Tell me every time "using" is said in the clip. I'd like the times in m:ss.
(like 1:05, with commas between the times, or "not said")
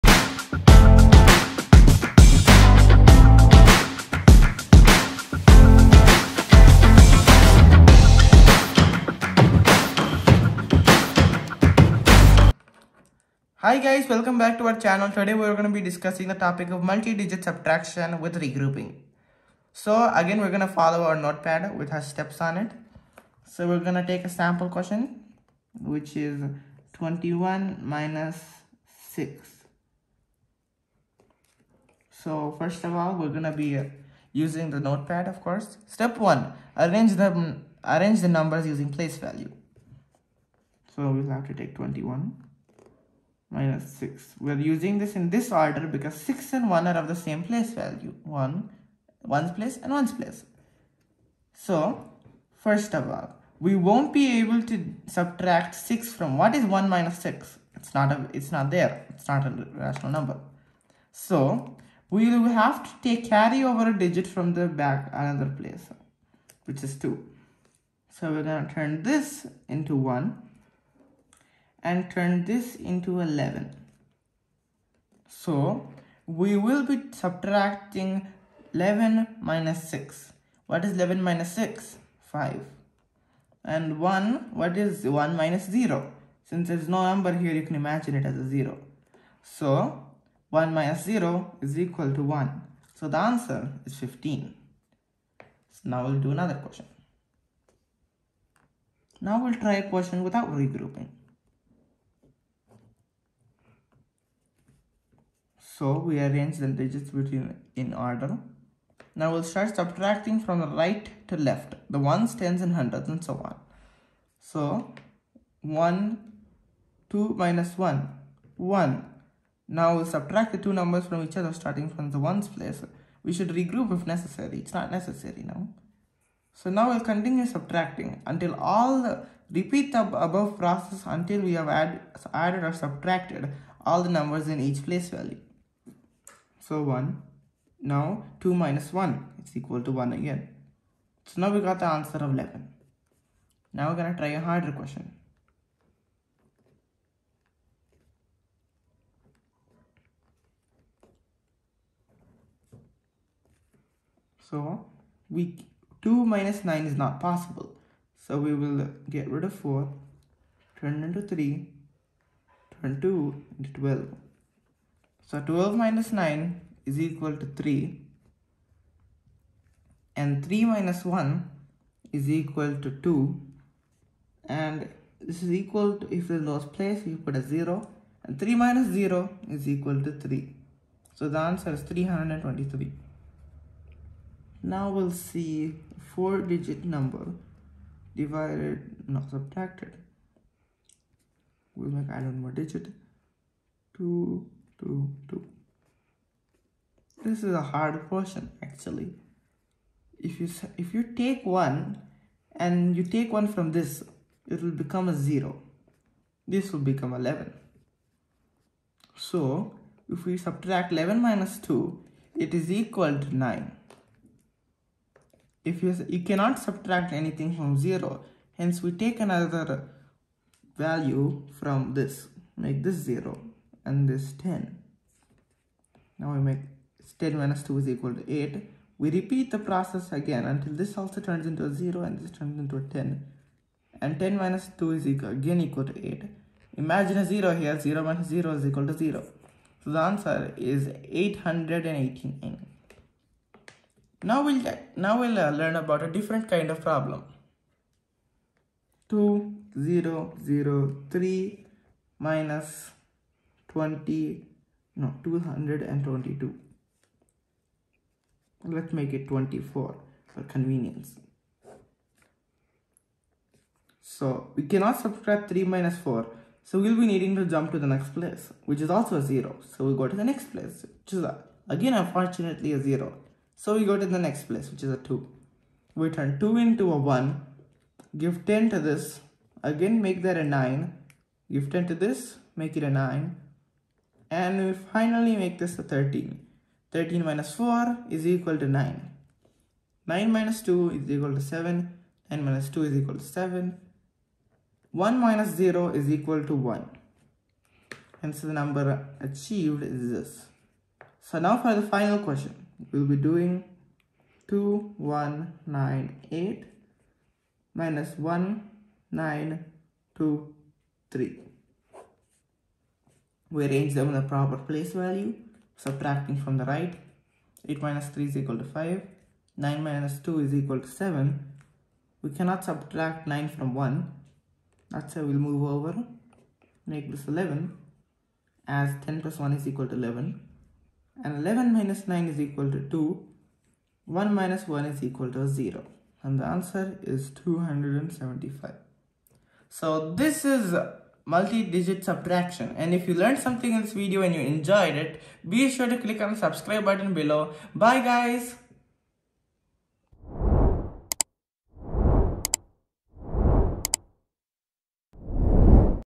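0:34, 0:38, 0:44.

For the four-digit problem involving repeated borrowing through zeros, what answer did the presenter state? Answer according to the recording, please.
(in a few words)
889.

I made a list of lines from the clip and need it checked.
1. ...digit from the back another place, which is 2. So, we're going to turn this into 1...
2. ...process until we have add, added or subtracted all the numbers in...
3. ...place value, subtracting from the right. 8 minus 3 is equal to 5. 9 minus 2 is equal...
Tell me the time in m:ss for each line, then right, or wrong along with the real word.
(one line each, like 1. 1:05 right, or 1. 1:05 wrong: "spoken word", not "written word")
1. 1:03 right
2. 2:10 right
3. 5:14 right.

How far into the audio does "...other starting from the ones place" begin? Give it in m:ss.
2:01.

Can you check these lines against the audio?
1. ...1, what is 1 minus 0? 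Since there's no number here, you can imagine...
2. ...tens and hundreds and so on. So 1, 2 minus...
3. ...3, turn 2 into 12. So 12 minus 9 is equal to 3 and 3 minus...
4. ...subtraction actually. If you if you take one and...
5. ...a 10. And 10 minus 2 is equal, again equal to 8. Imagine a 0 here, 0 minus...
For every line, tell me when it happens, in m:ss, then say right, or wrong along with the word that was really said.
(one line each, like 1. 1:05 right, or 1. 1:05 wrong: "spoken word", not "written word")
1. 1:23 right
2. 1:52 right
3. 2:41 right
4. 3:18 wrong: "question", not "subtraction"
5. 3:52 right.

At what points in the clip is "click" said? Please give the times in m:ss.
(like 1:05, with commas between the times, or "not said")
5:45.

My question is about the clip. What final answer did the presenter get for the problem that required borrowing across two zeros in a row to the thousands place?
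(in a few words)
1979.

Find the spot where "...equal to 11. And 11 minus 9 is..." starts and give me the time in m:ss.
5:29.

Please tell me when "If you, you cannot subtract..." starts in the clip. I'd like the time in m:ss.
3:35.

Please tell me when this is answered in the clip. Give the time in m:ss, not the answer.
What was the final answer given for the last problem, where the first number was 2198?
5:37.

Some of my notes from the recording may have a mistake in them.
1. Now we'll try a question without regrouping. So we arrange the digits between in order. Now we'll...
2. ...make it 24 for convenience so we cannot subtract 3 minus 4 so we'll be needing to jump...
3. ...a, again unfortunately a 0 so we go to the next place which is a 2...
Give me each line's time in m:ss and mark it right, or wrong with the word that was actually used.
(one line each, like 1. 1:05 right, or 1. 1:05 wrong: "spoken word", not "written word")
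1. 1:39 right
2. 4:18 right
3. 4:31 right.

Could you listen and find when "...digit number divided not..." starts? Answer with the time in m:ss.
3:06.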